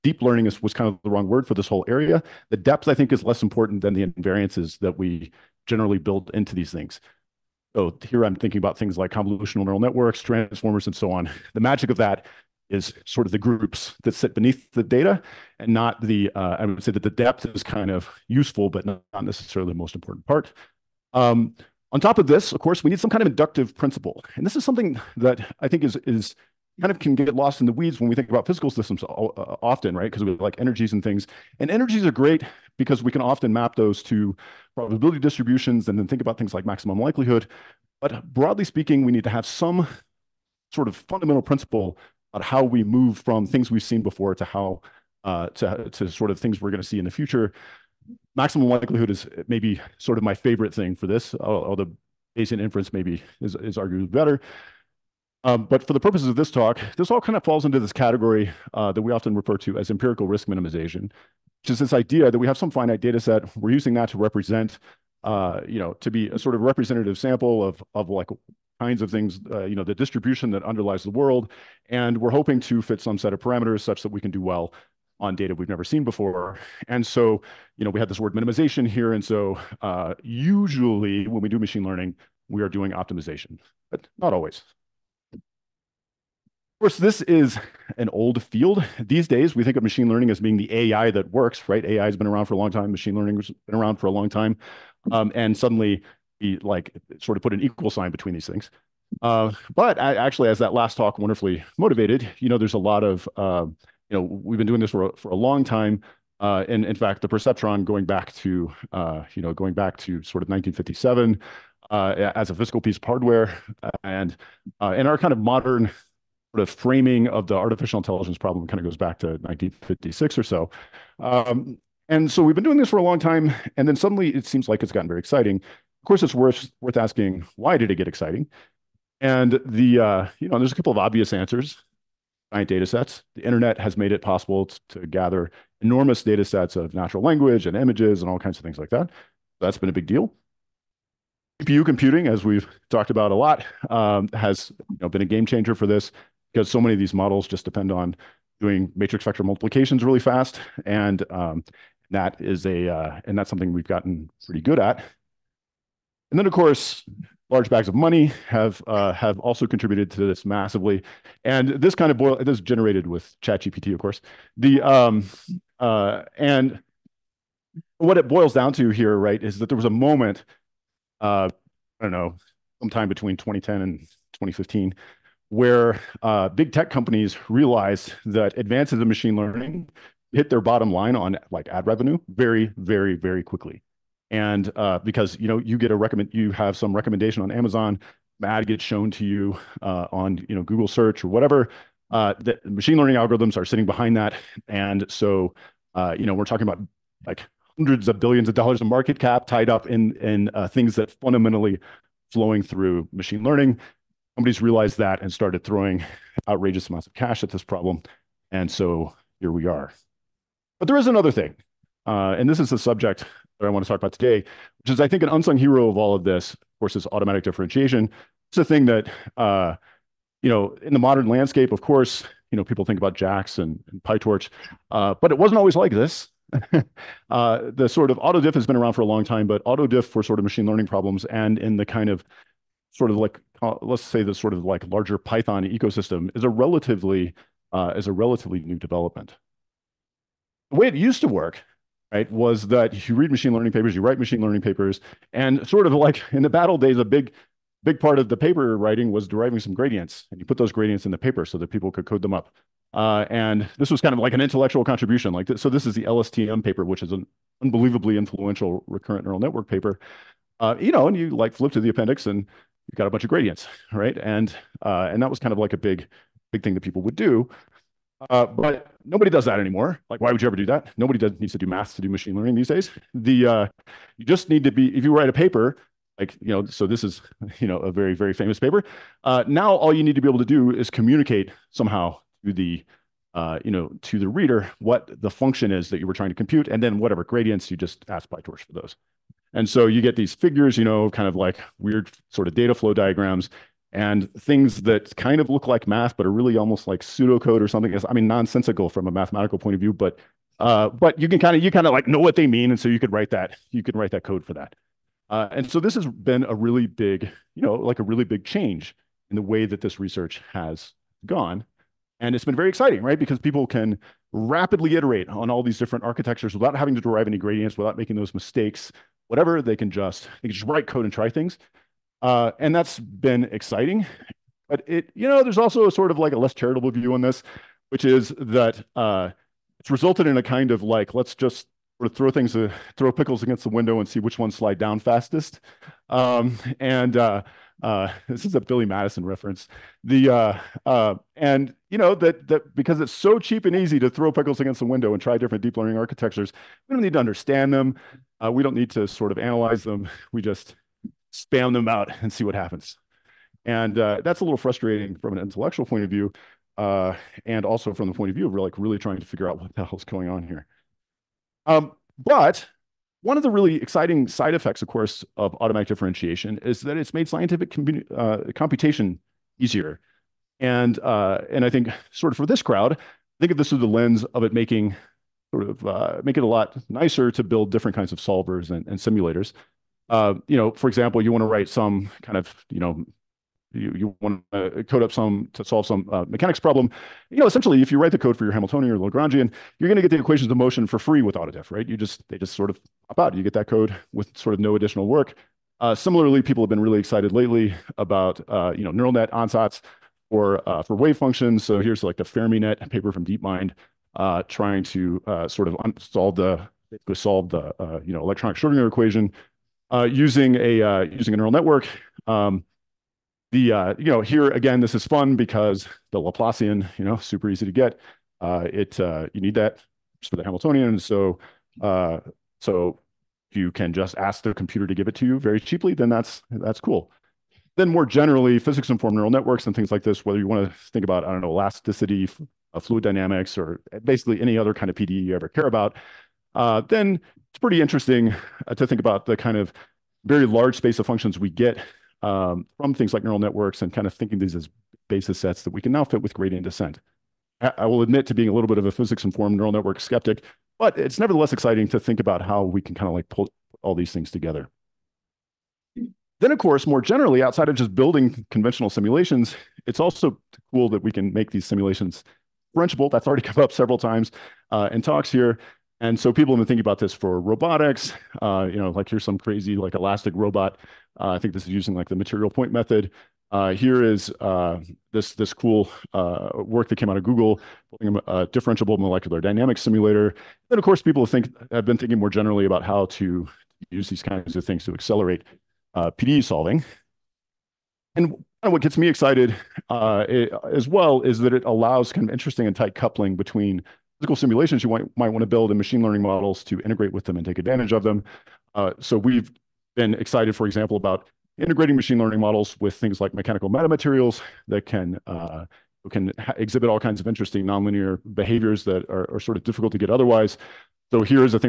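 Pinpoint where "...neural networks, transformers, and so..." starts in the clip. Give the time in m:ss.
0:09.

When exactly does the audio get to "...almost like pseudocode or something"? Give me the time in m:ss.
4:56.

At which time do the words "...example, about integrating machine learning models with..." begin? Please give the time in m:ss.
8:20.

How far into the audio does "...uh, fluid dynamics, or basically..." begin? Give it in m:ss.
7:12.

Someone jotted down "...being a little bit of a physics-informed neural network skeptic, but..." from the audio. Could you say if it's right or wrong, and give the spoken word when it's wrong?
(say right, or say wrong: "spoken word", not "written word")
right.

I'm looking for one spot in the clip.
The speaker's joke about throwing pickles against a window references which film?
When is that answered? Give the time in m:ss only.
5:38.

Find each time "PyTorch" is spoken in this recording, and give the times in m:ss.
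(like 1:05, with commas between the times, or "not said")
3:44, 4:48.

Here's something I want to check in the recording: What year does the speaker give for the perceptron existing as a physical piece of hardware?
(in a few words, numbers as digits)
1957.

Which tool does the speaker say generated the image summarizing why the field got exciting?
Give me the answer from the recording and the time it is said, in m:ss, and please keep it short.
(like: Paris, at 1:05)
ChatGPT, at 2:43.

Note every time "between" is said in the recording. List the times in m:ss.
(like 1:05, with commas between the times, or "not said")
1:38, 2:53, 8:13.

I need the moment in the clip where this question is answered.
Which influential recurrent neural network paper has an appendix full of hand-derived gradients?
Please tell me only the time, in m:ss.
4:15.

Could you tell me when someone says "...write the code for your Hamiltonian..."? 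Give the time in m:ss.
6:27.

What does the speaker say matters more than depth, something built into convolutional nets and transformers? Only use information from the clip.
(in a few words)
Invariances.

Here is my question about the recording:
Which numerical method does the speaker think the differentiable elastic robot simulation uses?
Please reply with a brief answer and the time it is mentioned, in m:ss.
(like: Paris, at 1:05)
Material point method, at 7:52.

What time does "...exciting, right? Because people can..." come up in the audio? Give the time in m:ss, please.
5:12.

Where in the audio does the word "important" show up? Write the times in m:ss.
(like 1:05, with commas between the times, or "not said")
0:03, 0:19.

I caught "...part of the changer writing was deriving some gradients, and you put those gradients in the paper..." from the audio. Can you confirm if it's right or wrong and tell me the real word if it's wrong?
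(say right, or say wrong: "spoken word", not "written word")
wrong: "paper", not "changer".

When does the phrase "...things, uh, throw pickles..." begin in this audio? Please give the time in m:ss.
5:32.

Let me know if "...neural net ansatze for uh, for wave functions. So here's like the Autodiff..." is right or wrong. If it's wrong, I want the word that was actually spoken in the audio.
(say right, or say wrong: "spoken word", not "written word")
wrong: "FermiNet", not "Autodiff".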